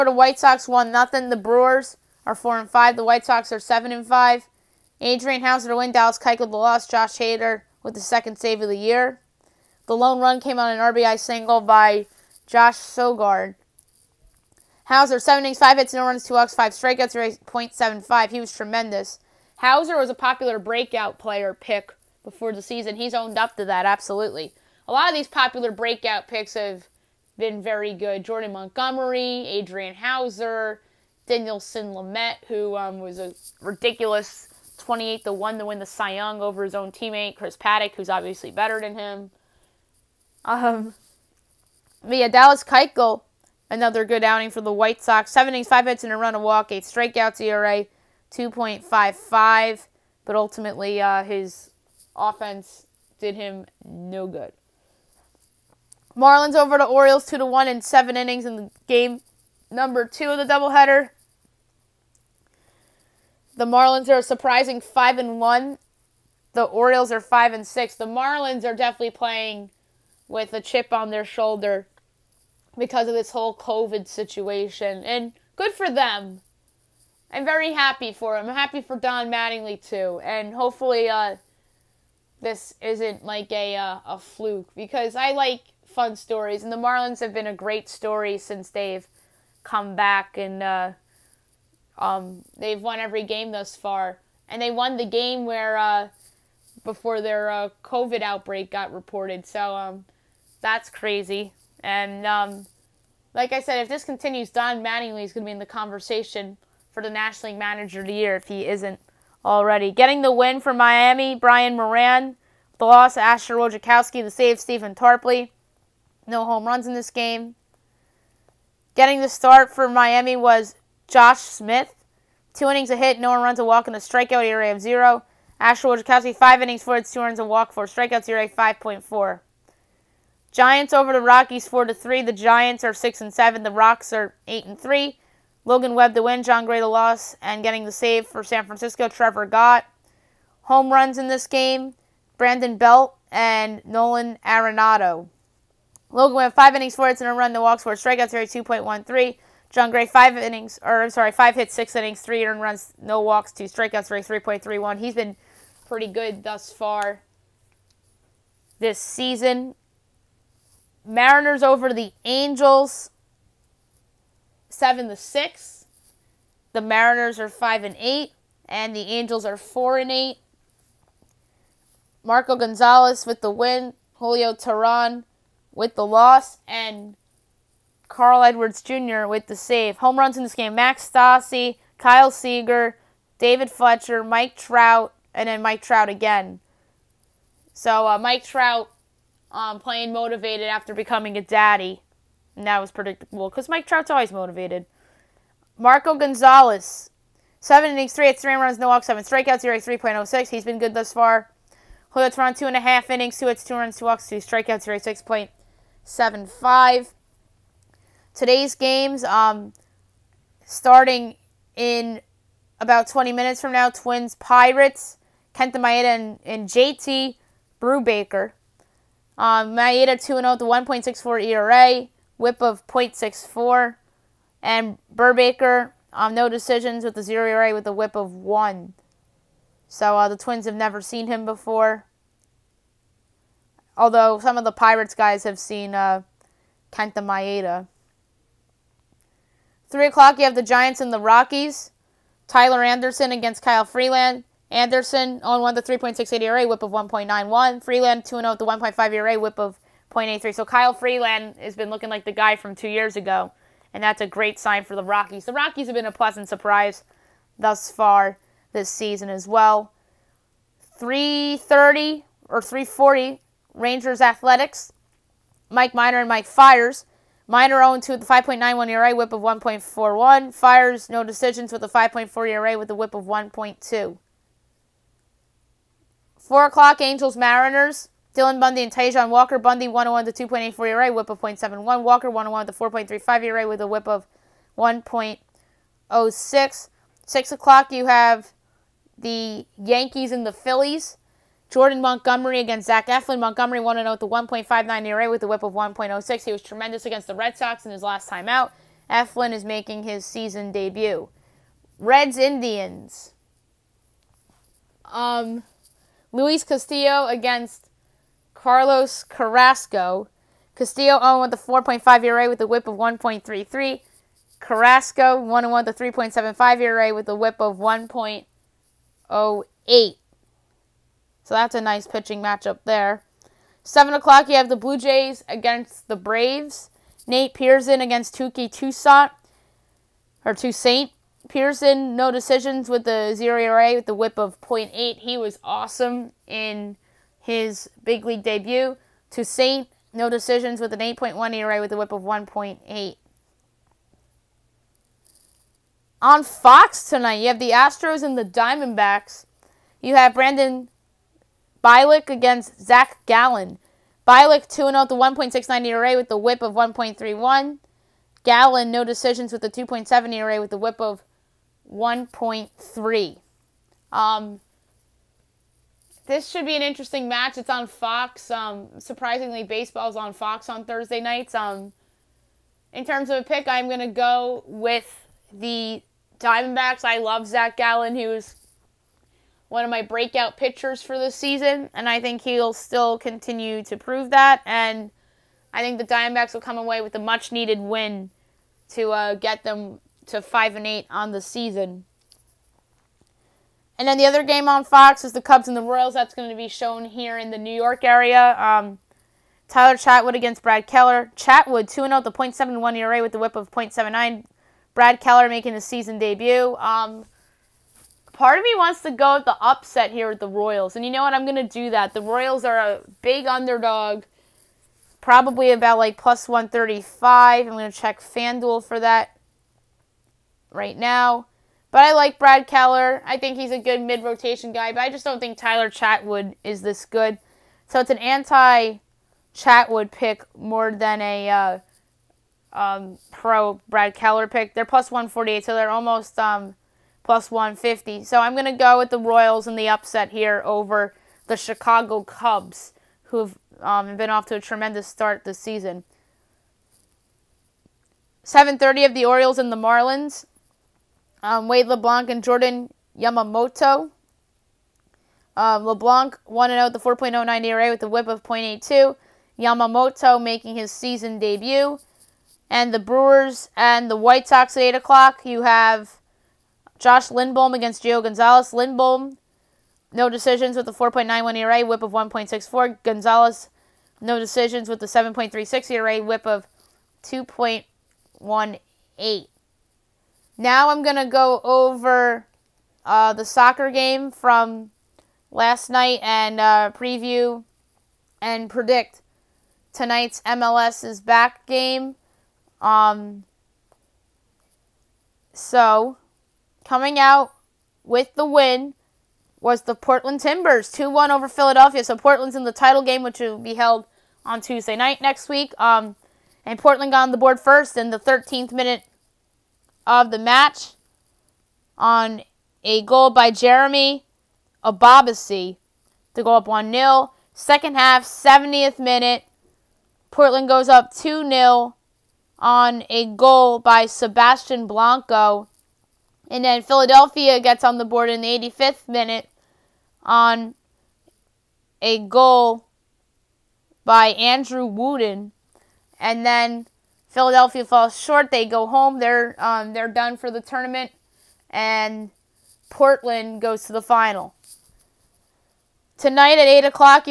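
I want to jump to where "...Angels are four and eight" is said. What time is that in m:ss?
2:49.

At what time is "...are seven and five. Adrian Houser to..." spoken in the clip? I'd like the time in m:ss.
0:03.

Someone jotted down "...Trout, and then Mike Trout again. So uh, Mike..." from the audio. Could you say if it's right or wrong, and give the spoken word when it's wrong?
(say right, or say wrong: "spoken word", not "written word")
right.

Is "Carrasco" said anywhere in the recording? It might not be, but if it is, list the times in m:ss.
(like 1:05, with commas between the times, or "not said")
5:09, 5:14.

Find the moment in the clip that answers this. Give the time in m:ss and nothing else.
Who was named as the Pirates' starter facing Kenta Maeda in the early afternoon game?
3:36.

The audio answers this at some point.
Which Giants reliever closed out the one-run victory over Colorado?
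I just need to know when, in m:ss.
2:19.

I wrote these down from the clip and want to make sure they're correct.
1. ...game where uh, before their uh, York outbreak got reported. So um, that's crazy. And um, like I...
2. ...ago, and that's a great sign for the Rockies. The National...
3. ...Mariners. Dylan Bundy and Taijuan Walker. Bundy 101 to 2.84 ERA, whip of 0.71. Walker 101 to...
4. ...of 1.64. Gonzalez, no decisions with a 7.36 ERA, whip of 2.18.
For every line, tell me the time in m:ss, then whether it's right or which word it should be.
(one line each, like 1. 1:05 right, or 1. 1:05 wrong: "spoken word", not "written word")
1. 1:35 wrong: "COVID", not "York"
2. 4:13 wrong: "Rockies", not "National"
3. 4:37 right
4. 7:52 right.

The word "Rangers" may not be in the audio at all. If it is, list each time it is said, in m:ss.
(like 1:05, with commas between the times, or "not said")
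4:23.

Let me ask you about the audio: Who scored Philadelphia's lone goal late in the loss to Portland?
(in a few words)
Andrew Wooten.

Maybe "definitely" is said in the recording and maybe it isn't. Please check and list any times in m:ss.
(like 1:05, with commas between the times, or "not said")
1:08.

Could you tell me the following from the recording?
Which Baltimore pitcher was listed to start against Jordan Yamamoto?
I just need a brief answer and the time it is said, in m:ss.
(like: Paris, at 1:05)
Wade LeBlanc, at 7:31.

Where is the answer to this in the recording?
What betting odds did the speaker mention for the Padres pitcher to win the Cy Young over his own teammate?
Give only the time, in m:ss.
0:34.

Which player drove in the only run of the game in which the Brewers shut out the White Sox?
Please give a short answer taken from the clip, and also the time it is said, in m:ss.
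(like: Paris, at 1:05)
Josh Sogard, at 0:12.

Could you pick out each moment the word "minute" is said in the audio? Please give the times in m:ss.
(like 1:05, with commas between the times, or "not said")
3:33, 8:28, 8:38, 8:49.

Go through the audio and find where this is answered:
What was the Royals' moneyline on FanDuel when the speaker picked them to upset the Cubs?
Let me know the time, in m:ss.
7:14.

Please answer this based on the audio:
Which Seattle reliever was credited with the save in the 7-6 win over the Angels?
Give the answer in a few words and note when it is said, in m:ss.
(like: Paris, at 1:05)
Carl Edwards Jr., at 2:58.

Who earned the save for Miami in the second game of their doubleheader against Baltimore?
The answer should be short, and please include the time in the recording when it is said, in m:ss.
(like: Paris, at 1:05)
Stephen Tarpley, at 1:54.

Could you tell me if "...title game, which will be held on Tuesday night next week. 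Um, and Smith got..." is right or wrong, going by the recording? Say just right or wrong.
wrong.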